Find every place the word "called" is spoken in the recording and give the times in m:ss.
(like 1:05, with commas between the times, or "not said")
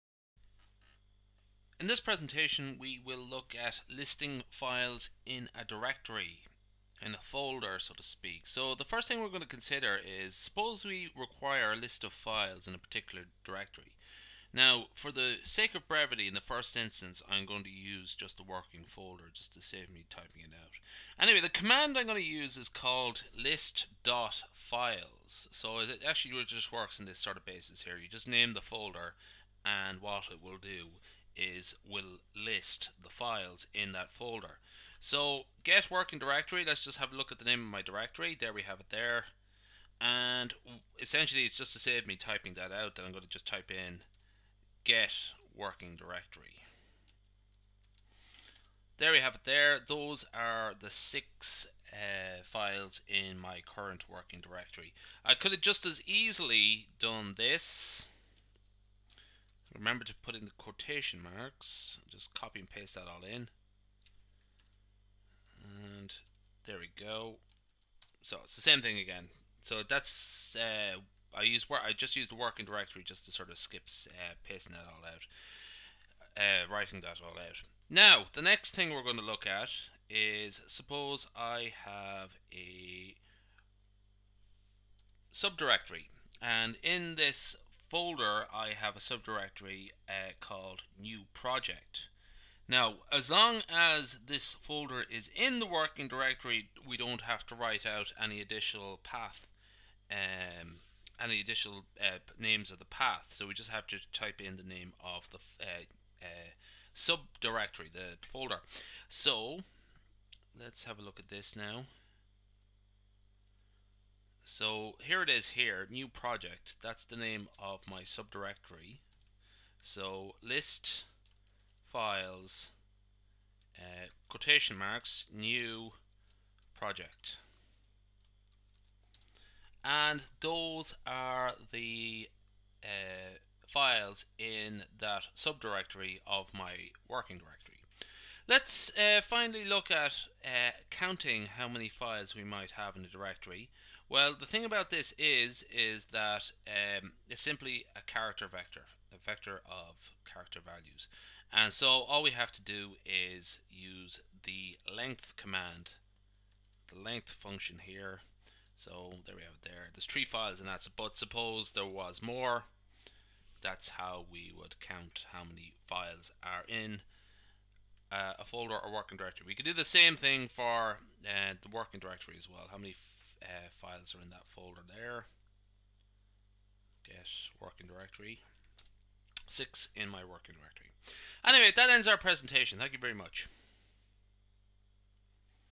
0:22, 1:30.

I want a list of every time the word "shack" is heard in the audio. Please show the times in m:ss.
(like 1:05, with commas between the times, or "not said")
not said.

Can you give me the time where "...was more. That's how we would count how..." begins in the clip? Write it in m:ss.
2:41.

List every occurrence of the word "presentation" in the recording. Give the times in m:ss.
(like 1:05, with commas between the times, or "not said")
0:01, 3:02.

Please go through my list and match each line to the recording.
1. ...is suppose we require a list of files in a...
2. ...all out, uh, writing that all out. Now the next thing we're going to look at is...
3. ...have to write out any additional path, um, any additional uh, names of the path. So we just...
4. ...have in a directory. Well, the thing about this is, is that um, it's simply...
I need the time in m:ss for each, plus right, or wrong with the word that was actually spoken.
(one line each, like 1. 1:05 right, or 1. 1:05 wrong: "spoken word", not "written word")
1. 0:09 right
2. 1:14 right
3. 1:37 right
4. 2:22 right.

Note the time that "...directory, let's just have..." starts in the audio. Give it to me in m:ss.
0:36.